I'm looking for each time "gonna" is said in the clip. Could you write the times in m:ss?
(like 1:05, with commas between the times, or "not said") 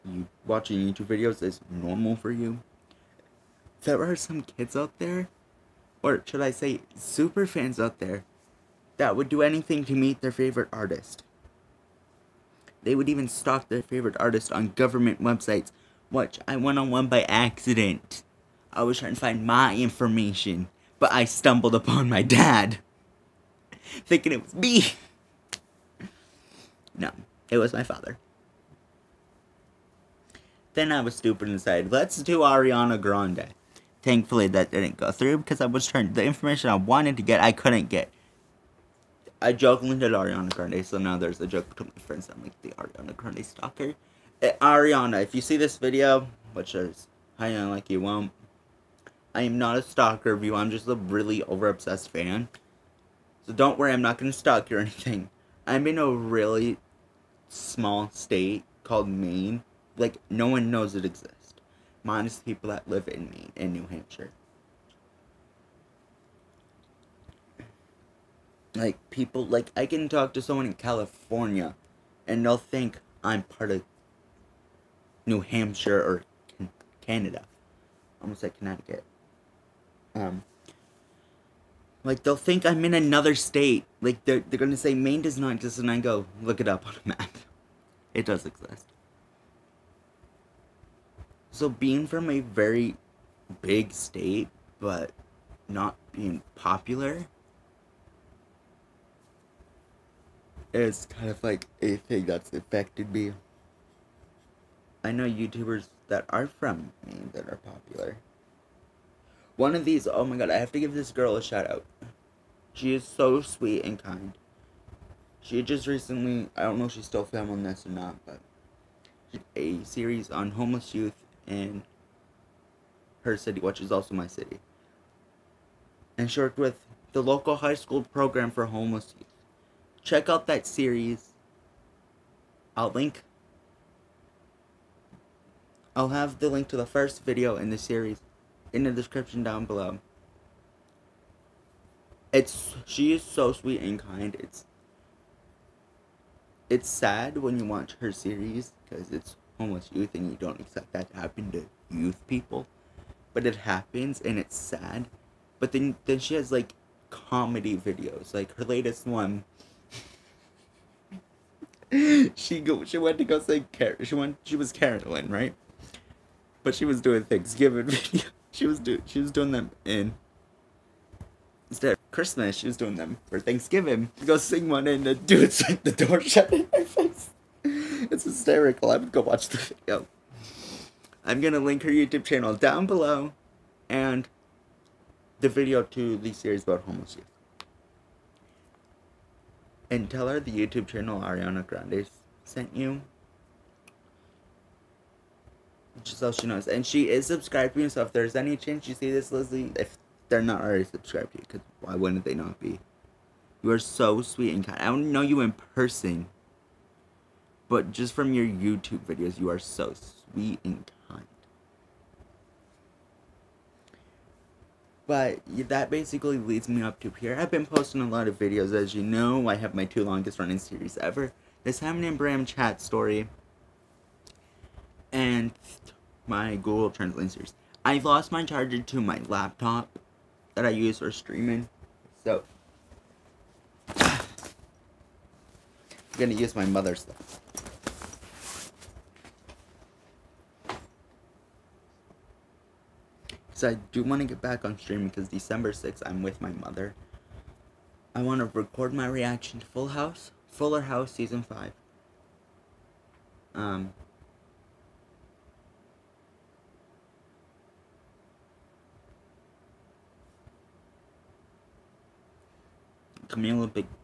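0:54, 1:24, 3:01, 3:56.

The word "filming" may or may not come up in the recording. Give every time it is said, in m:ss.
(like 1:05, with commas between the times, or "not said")
1:57.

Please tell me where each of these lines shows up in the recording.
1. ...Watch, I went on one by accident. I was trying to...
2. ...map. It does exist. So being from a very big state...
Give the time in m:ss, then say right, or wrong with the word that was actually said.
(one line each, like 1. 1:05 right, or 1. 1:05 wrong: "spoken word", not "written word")
1. 0:16 right
2. 1:27 right.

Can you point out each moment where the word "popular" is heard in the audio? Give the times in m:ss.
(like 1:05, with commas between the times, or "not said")
1:36, 1:47.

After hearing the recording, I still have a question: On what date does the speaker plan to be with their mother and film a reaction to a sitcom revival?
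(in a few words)
December 6.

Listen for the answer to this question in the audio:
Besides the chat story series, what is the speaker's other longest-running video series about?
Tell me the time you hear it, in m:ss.
3:46.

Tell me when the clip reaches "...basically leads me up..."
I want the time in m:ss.
3:35.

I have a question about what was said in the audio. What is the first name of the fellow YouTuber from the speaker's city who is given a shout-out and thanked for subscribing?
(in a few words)
Leslie.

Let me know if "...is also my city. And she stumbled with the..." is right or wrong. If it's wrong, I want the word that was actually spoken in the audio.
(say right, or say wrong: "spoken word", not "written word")
wrong: "worked", not "stumbled".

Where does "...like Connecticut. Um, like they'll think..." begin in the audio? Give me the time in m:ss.
1:18.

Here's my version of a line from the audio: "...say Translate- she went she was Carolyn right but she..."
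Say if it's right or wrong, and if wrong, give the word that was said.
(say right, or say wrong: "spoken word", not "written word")
wrong: "Car", not "Translate".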